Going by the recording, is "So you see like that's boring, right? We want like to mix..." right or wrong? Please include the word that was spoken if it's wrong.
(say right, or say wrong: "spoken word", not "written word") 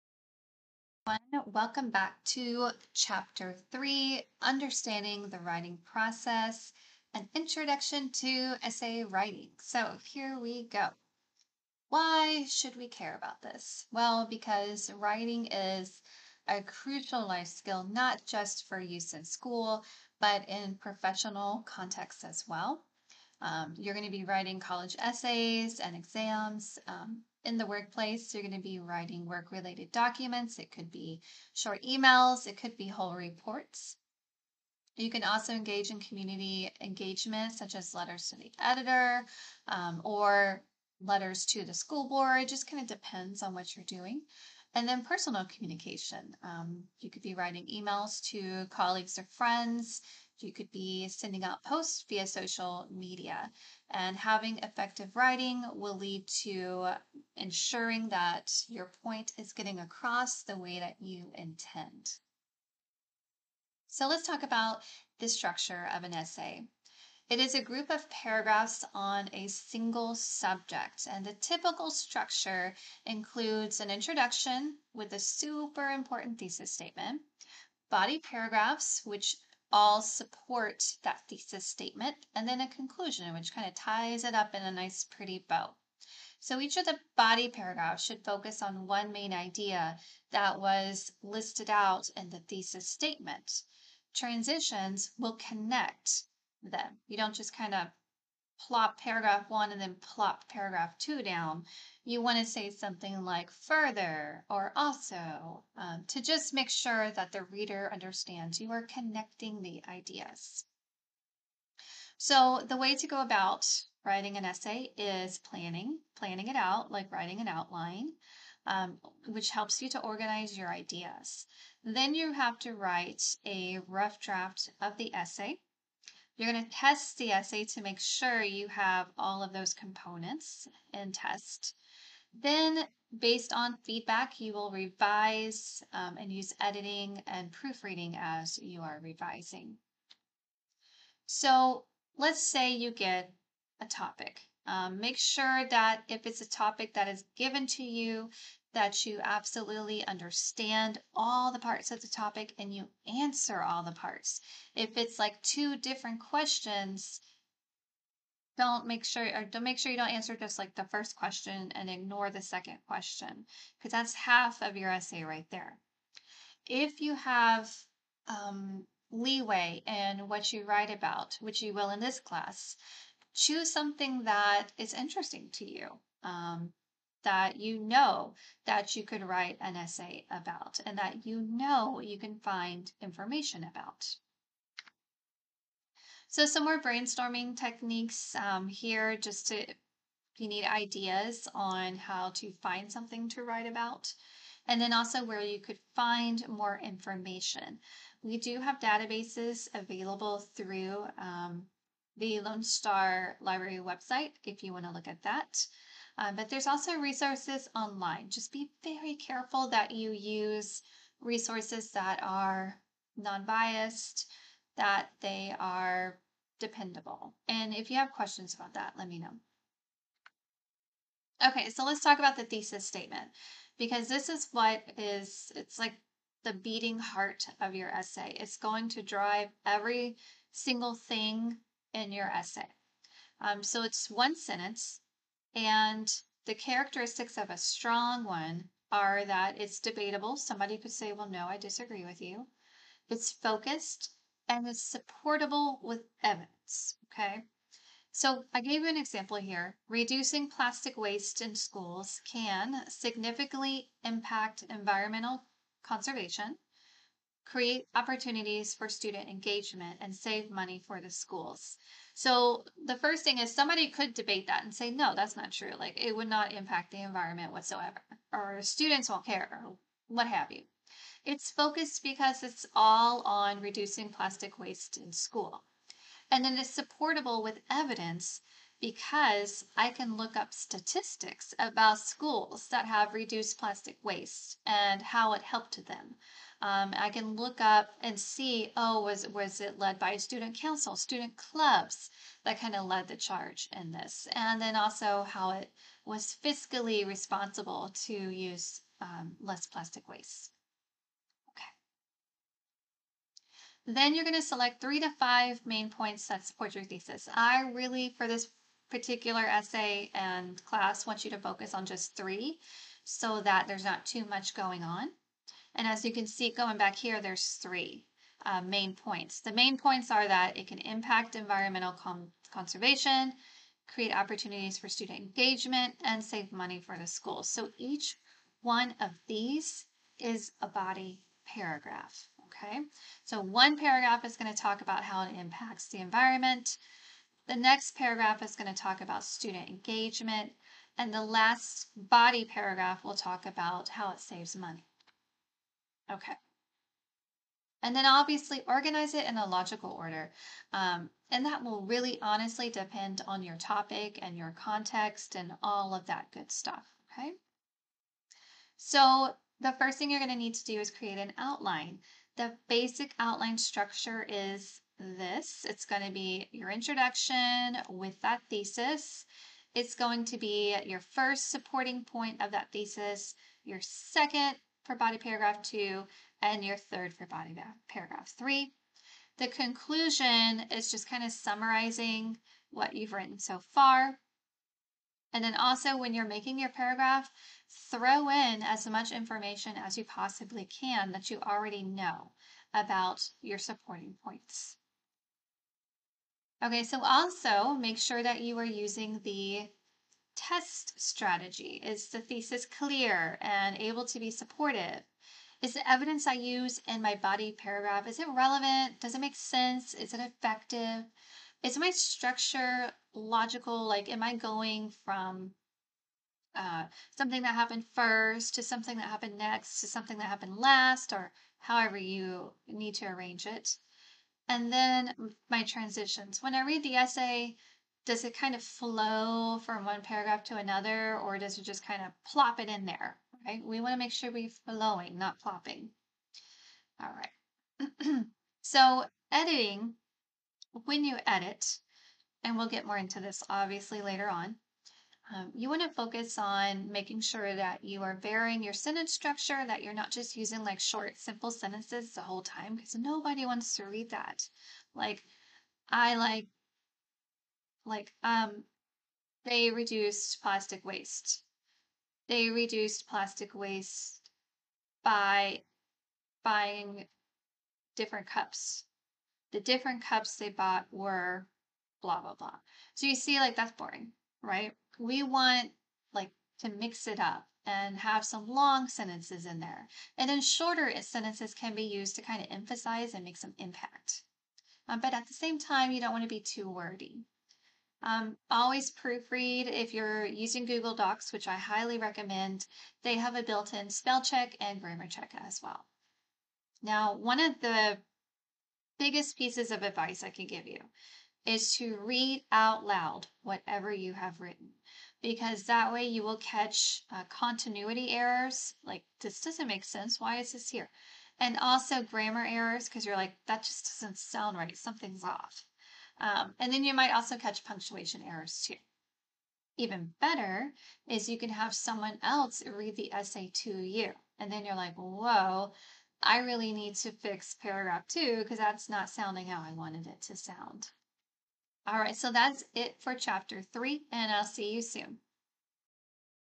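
right.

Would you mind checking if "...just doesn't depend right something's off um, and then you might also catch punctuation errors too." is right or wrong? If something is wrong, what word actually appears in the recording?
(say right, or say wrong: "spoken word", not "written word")
wrong: "sound", not "depend".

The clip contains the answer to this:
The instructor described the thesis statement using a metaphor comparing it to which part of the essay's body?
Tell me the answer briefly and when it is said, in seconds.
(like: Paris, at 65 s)
beating heart, at 226 s.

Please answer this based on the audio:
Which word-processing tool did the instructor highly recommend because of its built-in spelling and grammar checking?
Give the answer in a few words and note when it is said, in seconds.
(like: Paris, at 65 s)
Google Docs, at 490 s.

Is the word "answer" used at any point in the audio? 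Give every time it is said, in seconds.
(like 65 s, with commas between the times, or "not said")
153 s, 160 s.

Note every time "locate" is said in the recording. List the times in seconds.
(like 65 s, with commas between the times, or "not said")
not said.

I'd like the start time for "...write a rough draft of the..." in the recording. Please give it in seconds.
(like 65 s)
122 s.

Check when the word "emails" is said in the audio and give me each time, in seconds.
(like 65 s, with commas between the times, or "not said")
31 s, 47 s.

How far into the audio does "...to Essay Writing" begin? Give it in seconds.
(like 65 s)
8 s.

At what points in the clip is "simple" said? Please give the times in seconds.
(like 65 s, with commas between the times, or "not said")
451 s.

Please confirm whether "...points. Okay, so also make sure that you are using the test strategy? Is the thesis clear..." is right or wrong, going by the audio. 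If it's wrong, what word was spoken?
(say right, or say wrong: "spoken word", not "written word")
right.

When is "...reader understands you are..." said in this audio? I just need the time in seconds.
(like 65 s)
107 s.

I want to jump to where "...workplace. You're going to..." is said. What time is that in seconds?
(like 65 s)
27 s.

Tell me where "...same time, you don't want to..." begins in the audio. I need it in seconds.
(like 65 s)
485 s.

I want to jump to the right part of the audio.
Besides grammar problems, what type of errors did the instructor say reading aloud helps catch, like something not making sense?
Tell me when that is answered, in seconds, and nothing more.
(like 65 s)
507 s.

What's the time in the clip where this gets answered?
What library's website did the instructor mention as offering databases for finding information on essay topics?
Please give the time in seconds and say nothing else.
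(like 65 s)
202 s.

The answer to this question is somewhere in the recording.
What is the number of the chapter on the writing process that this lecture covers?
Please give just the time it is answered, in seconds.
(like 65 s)
2 s.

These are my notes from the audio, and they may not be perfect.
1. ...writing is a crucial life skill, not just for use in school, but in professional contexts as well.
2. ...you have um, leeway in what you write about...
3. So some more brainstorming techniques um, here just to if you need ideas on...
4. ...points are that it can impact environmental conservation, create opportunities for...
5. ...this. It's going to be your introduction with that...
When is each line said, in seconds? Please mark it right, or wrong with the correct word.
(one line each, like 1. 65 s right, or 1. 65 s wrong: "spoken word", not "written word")
1. 14 s right
2. 167 s right
3. 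186 s right
4. 319 s right
5. 364 s right.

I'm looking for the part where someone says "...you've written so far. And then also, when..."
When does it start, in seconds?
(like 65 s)
382 s.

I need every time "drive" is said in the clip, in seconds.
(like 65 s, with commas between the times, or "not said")
229 s.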